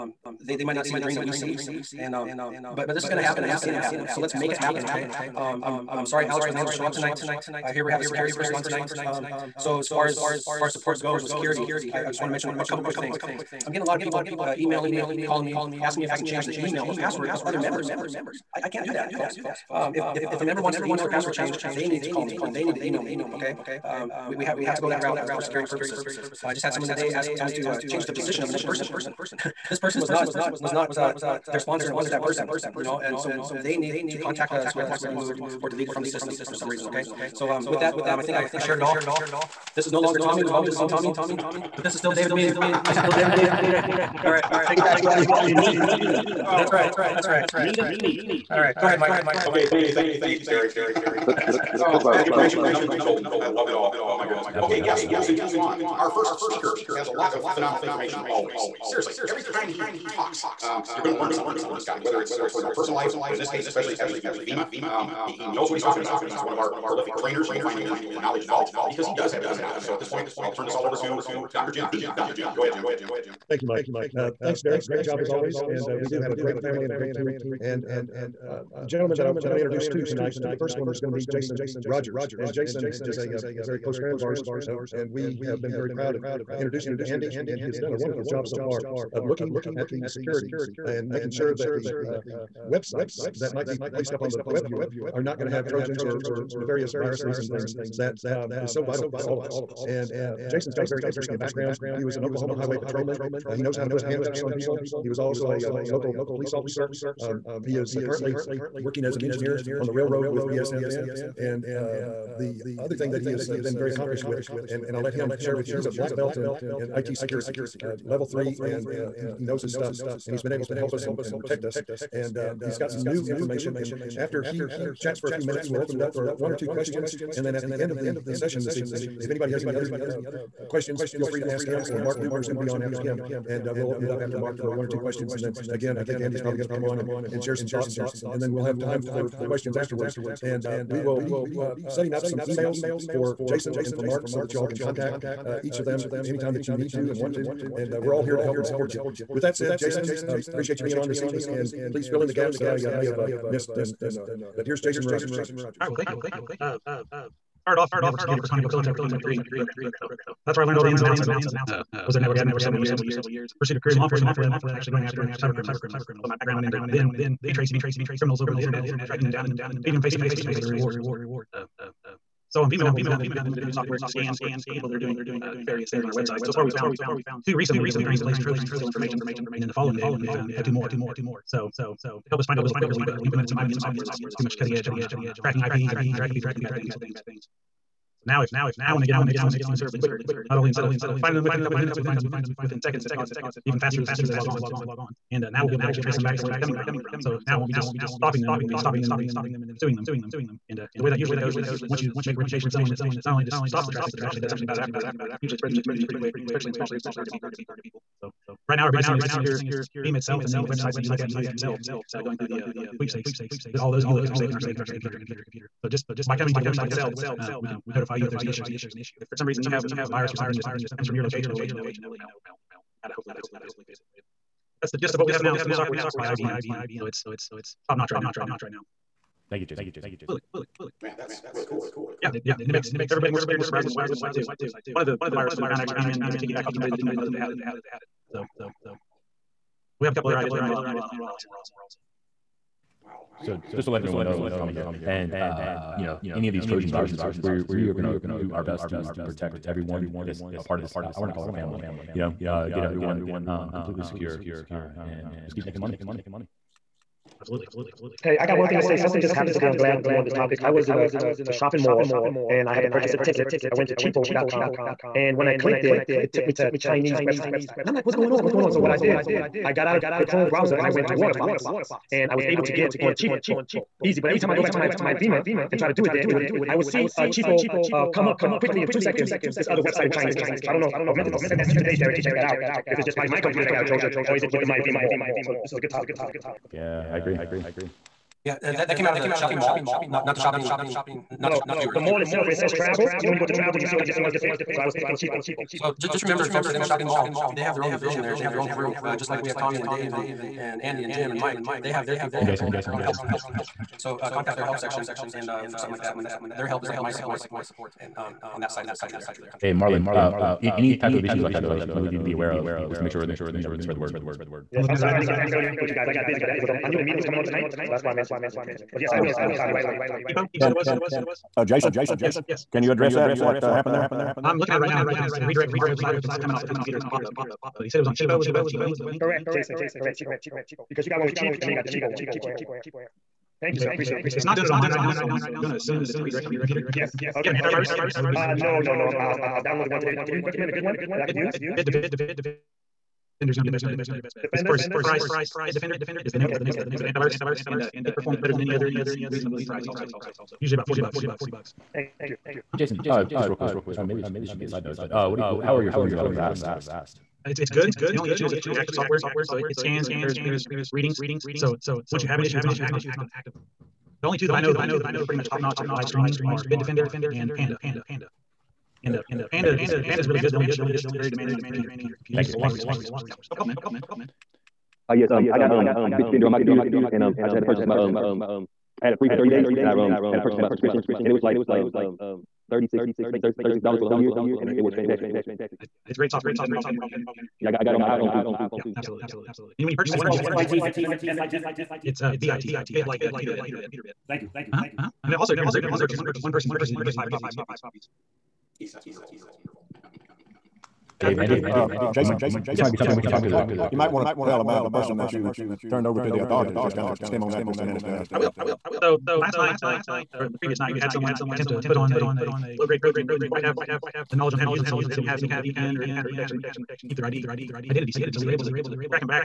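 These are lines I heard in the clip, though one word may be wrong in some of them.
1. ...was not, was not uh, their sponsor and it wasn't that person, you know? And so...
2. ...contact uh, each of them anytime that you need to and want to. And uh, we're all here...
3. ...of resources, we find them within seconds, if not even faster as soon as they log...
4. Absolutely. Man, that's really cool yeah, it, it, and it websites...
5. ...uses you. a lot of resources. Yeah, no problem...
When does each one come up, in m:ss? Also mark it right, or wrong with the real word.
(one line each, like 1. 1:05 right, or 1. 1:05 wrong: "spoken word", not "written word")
1. 0:30 right
2. 2:24 right
3. 3:11 wrong: "minutes", not "resources"
4. 3:50 wrong: "makes", not "websites"
5. 6:12 right.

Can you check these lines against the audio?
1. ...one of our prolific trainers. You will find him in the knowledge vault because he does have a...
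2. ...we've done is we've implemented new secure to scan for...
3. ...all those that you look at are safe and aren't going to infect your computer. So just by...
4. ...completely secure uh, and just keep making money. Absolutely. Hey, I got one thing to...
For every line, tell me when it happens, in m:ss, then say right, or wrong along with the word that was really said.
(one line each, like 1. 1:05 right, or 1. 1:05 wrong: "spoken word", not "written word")
1. 1:06 right
2. 2:52 wrong: "software", not "secure"
3. 3:33 right
4. 4:13 right.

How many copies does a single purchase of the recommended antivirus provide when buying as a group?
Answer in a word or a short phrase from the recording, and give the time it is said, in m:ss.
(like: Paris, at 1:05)
5, at 6:37.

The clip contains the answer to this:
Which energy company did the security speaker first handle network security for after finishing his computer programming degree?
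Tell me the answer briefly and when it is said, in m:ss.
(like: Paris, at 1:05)
ConocoPhillips, at 2:38.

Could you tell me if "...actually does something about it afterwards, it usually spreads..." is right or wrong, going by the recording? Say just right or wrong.
right.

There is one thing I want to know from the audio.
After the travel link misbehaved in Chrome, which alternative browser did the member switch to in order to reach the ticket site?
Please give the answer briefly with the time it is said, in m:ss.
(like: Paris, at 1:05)
Waterfox, at 4:31.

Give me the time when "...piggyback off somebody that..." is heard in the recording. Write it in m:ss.
3:56.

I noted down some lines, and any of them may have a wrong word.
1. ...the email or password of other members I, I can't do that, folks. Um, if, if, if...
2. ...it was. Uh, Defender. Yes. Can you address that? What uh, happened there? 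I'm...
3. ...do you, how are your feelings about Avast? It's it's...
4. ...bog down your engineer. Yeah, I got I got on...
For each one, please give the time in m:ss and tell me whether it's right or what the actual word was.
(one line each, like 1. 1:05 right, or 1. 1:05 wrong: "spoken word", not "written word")
1. 0:16 right
2. 5:20 wrong: "Jason", not "Defender"
3. 5:55 right
4. 6:26 wrong: "computer", not "engineer".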